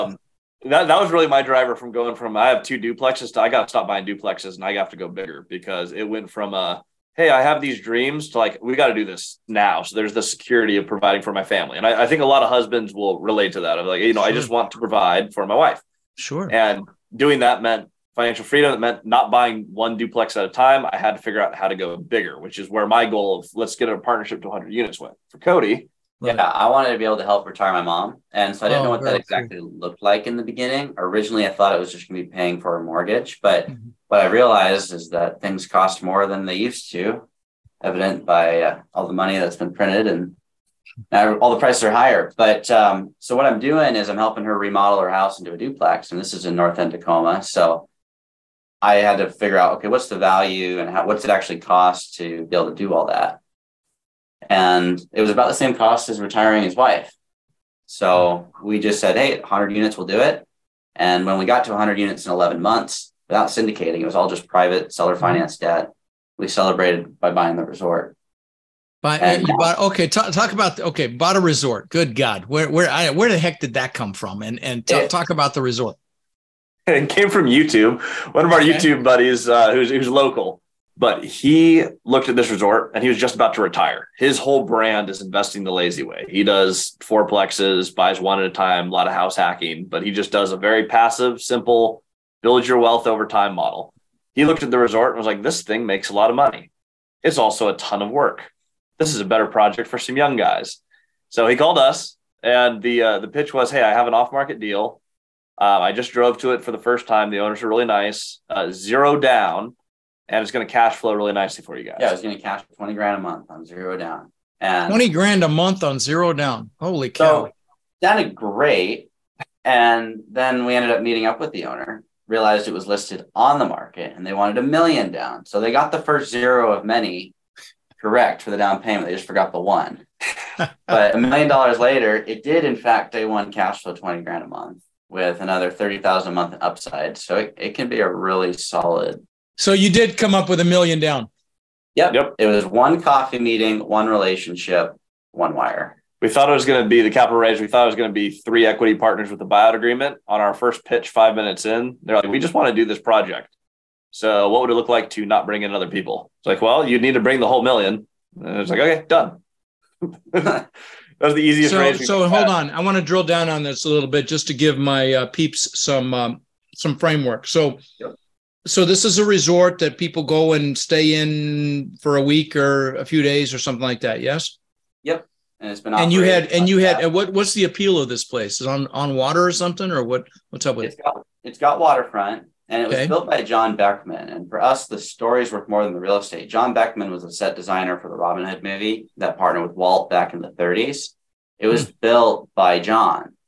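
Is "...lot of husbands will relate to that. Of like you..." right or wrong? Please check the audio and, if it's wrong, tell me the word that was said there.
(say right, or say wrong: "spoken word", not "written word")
right.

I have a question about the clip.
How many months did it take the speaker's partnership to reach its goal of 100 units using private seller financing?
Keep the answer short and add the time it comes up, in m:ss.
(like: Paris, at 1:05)
11 months, at 1:02.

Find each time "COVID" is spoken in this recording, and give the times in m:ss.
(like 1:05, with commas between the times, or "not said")
not said.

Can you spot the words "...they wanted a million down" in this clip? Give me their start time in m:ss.
2:04.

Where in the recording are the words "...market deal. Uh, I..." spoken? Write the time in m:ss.
1:44.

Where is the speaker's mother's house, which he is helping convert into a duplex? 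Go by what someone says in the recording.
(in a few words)
North End Tacoma.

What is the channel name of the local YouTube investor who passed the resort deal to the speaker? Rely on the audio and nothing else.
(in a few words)
investing the lazy way.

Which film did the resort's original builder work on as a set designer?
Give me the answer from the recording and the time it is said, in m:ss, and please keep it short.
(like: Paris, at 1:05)
Robin Hood, at 3:08.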